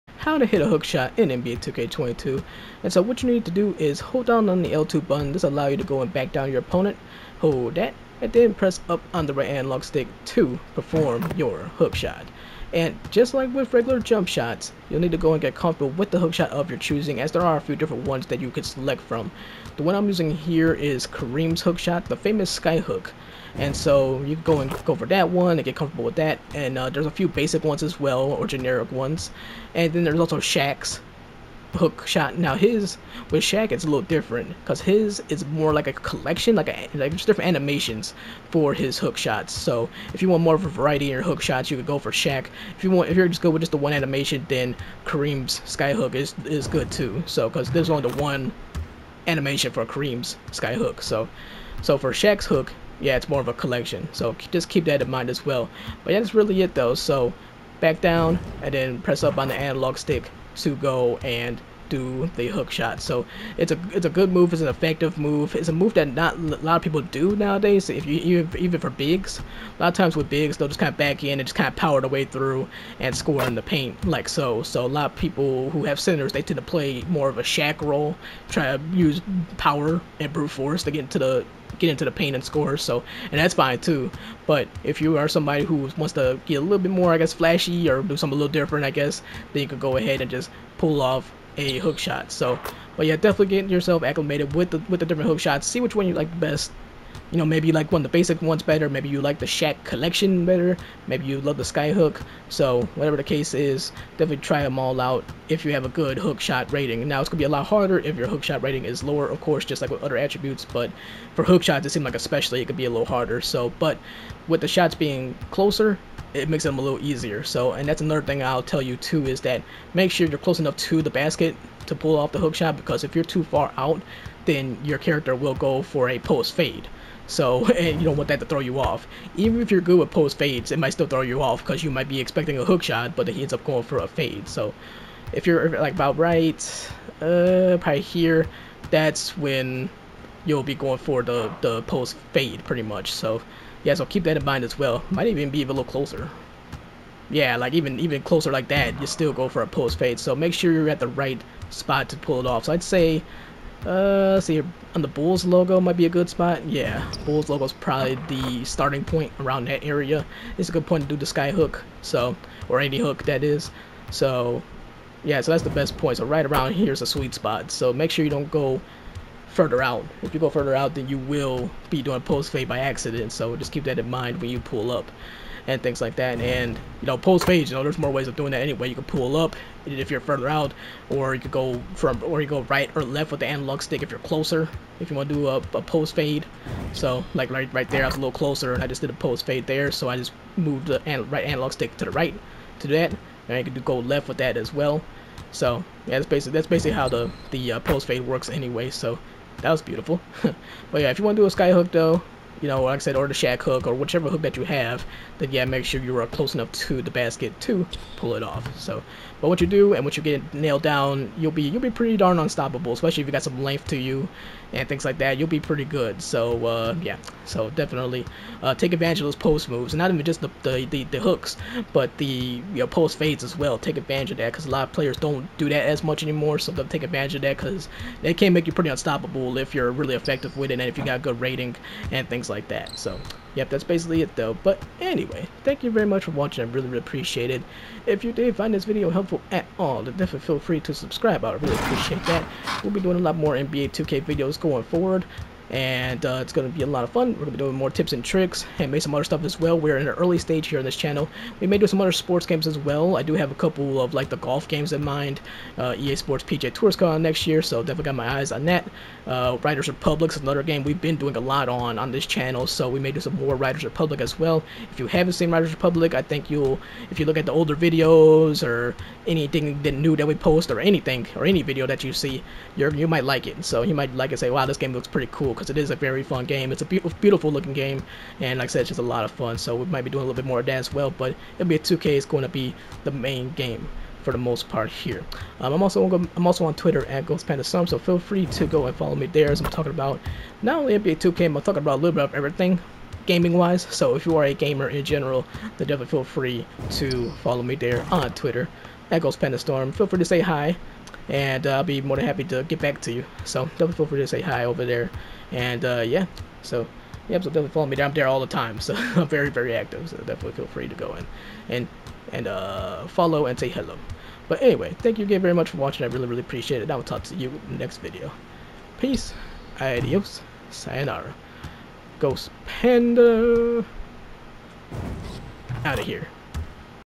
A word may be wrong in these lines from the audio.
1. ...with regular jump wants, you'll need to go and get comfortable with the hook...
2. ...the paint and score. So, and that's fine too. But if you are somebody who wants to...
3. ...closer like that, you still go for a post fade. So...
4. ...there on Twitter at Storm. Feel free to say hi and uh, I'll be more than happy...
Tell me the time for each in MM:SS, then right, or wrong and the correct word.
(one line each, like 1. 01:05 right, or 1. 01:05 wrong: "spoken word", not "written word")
1. 00:13 wrong: "shots", not "wants"
2. 01:22 right
3. 02:28 right
4. 04:57 right.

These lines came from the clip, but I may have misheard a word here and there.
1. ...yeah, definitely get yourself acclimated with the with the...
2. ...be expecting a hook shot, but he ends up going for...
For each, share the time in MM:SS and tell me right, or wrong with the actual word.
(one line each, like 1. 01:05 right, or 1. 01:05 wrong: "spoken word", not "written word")
1. 01:33 right
2. 02:12 right.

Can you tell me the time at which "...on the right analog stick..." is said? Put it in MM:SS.
00:09.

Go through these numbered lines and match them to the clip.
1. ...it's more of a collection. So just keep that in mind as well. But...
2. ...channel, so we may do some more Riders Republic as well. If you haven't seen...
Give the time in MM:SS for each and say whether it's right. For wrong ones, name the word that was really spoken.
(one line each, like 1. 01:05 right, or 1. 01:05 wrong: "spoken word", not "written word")
1. 00:53 right
2. 04:22 right.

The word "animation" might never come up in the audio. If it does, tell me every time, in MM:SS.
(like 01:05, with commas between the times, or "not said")
00:37, 00:43, 00:49.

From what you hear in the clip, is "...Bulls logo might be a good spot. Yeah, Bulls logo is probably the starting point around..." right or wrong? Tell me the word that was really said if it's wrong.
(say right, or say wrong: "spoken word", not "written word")
right.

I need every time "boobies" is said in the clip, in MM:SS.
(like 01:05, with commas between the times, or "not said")
not said.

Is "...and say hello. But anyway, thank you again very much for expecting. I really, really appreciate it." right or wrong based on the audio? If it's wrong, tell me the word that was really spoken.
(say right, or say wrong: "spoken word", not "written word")
wrong: "watching", not "expecting".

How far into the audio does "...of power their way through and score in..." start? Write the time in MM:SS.
01:11.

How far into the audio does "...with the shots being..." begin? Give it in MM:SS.
01:54.